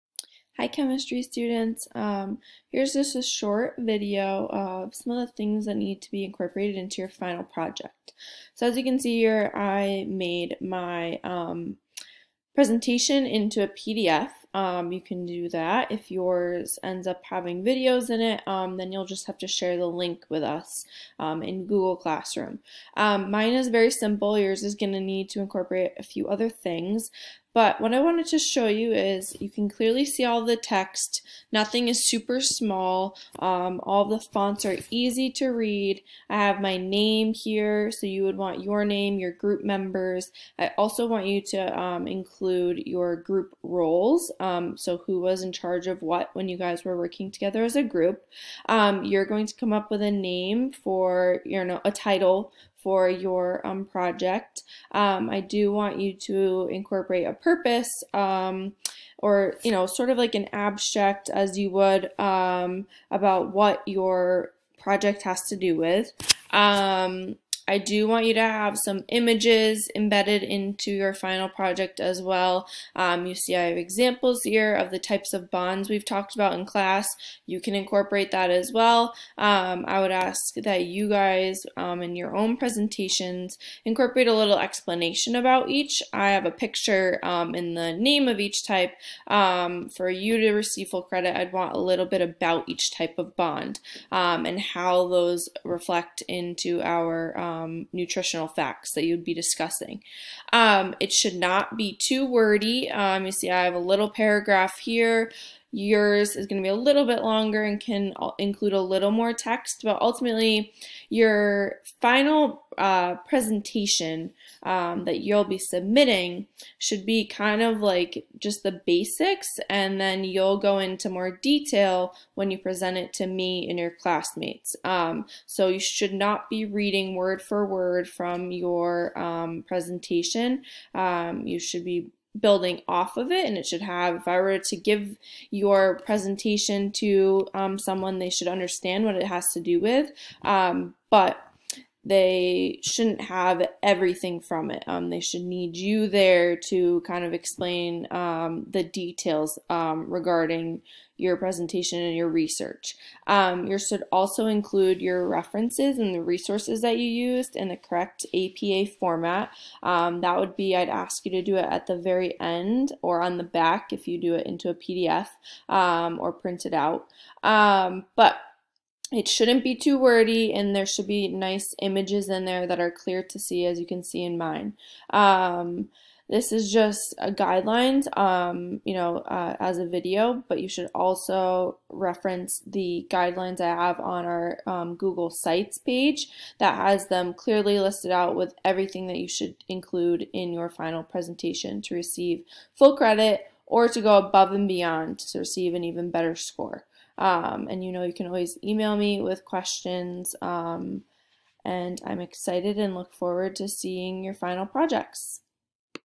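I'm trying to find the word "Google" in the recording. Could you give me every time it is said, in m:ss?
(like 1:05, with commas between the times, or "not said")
0:21, 3:04.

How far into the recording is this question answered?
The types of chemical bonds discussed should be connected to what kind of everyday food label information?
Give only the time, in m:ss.
1:37.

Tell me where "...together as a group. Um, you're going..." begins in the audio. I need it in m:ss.
0:47.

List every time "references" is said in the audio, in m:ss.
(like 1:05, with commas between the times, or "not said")
2:35, 3:01.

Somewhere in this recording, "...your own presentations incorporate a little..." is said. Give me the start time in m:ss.
1:22.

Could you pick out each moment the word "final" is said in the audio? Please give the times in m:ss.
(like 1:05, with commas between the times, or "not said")
0:07, 1:11, 1:52, 3:10, 3:24.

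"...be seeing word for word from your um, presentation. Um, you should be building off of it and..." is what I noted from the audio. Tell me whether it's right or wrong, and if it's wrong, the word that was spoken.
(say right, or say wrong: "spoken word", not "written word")
wrong: "reading", not "seeing".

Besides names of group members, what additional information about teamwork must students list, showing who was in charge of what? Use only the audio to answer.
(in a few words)
group roles.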